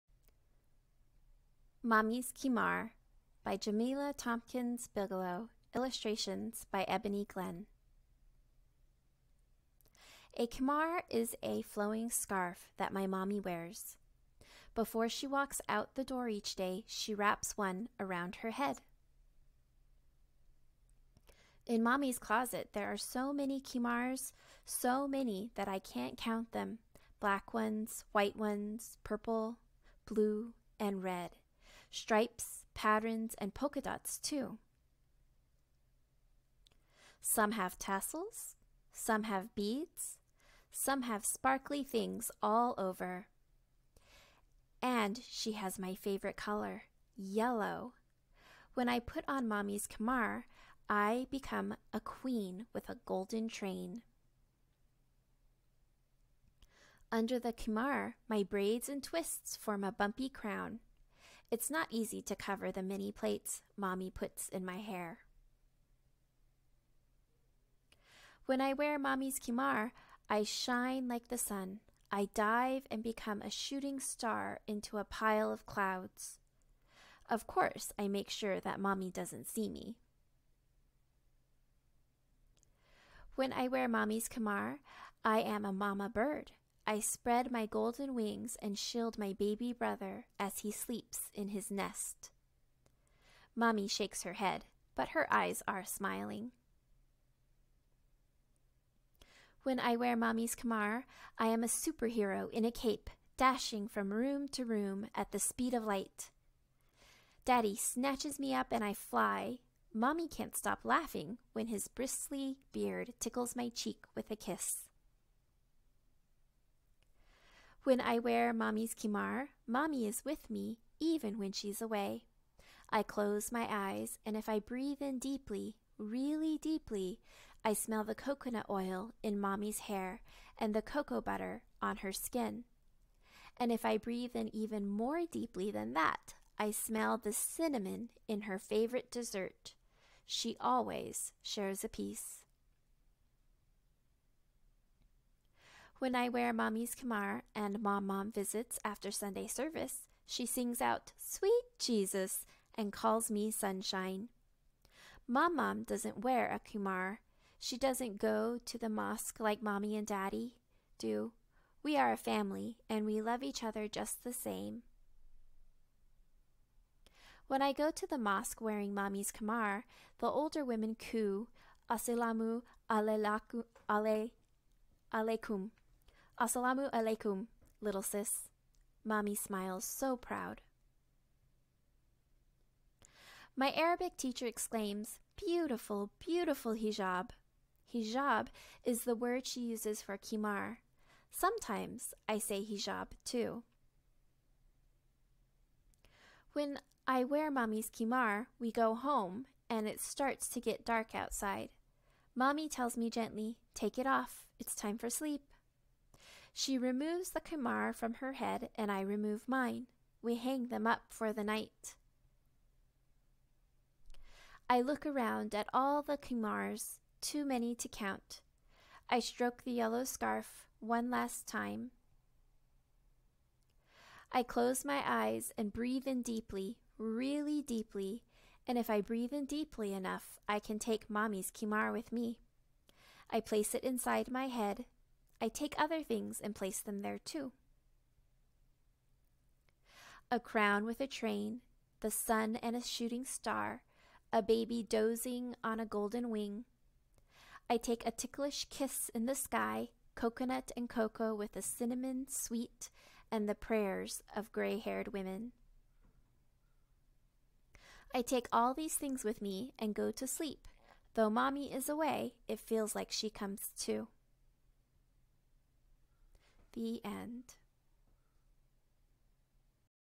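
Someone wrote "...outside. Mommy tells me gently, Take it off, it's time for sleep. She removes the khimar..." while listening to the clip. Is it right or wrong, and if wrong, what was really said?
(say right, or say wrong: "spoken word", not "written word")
right.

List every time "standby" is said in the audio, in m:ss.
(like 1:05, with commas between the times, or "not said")
not said.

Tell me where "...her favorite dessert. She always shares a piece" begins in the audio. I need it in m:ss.
2:18.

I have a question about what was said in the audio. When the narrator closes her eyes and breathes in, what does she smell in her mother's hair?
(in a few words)
Coconut oil.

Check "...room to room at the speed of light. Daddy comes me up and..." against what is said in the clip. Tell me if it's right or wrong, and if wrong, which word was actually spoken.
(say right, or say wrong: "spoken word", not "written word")
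wrong: "snatches", not "comes".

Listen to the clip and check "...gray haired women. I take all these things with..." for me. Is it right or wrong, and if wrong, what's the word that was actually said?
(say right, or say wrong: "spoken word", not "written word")
right.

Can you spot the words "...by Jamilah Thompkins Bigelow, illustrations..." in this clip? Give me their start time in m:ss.
0:03.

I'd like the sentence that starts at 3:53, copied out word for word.
I place it inside my head I take other things and place them there too.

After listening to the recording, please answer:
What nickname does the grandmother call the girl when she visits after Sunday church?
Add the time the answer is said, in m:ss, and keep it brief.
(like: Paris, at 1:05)
Sunshine, at 2:33.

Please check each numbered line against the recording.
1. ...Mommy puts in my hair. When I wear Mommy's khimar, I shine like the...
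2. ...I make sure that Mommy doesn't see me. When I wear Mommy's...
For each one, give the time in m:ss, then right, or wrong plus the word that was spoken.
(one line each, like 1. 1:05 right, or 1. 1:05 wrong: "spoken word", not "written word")
1. 1:03 right
2. 1:17 right.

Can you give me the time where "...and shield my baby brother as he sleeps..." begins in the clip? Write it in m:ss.
1:28.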